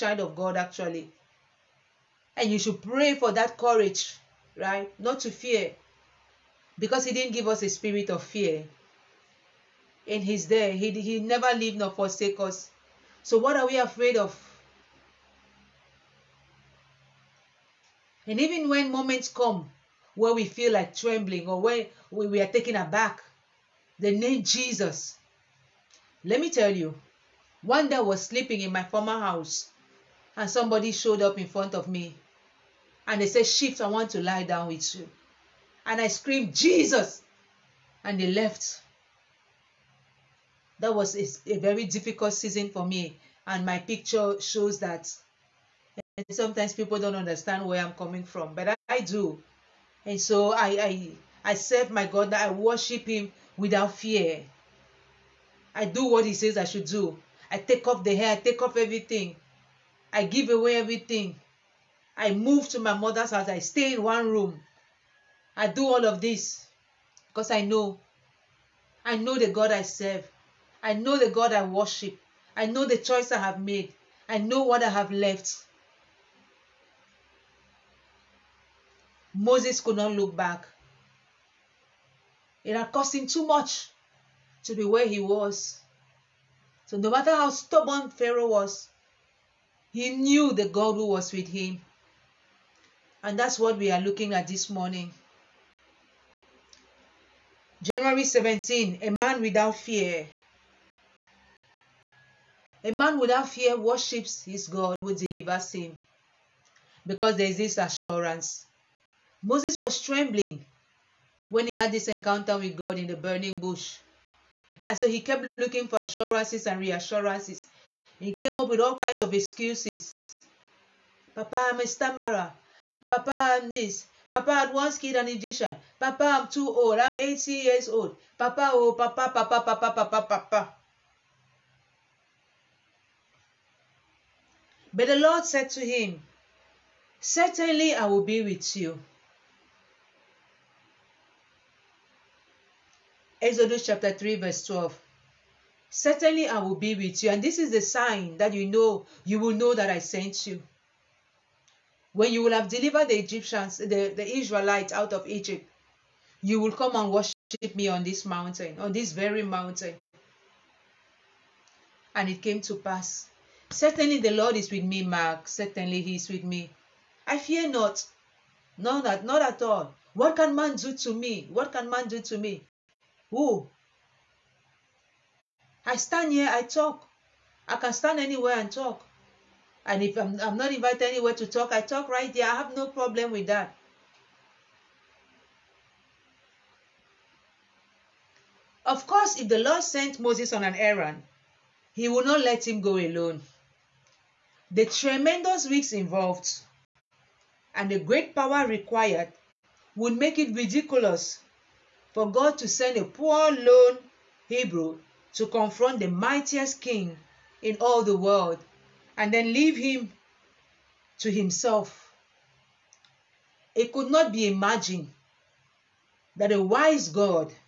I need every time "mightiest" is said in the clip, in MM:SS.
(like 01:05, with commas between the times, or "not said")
03:26.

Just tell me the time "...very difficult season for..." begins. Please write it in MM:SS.
00:41.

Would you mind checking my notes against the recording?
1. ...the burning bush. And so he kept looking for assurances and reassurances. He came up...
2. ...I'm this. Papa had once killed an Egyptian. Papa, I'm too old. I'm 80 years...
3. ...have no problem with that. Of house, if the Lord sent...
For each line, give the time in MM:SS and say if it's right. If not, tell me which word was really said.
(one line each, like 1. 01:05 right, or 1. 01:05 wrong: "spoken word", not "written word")
1. 01:53 right
2. 02:03 right
3. 03:02 wrong: "course", not "house".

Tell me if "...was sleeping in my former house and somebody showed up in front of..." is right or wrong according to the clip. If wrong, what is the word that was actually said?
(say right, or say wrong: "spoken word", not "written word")
right.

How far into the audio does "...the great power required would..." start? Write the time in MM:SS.
03:17.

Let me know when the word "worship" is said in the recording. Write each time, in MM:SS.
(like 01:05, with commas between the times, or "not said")
00:52, 01:11, 01:43, 02:37.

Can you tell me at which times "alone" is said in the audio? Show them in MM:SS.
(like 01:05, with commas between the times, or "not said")
03:12.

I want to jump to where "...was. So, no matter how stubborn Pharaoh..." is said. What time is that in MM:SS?
01:25.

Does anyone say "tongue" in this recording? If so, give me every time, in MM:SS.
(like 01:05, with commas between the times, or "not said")
not said.